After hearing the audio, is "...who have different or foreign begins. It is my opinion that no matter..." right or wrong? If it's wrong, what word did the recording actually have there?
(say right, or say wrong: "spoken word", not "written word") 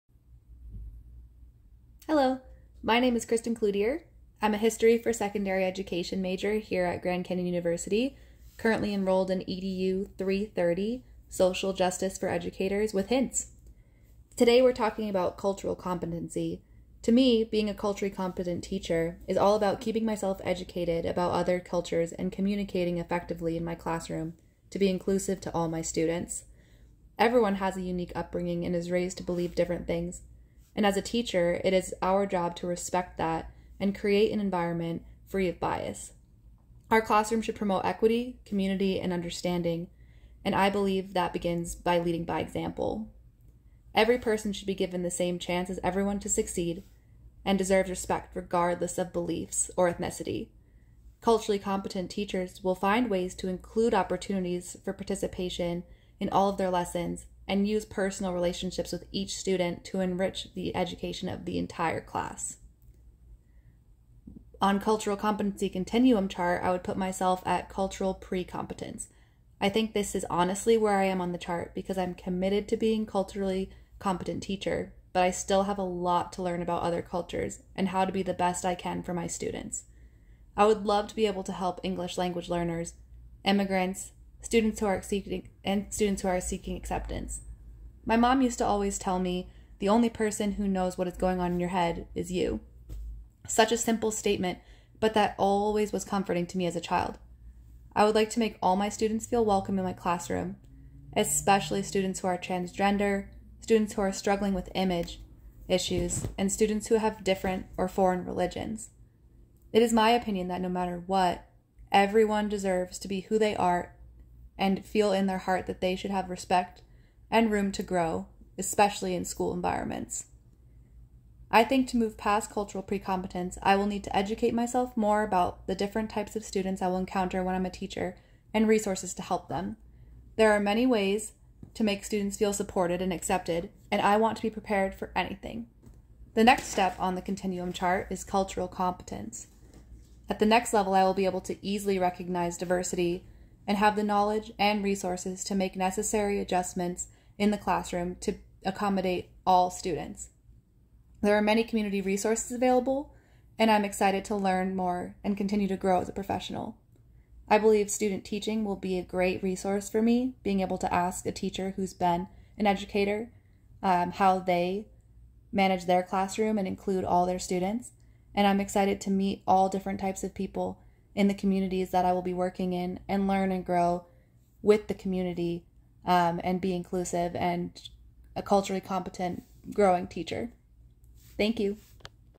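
wrong: "religions", not "begins".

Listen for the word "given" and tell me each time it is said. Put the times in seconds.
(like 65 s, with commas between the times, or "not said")
44 s.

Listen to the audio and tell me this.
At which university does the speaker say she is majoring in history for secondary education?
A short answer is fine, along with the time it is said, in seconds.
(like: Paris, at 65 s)
Grand Canyon University, at 7 s.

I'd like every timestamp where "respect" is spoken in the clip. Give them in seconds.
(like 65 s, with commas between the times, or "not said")
32 s, 47 s, 116 s.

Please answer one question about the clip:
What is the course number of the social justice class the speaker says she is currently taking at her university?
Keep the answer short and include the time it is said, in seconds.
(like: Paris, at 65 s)
EDU 330, at 9 s.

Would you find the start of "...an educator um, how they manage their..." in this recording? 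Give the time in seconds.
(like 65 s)
162 s.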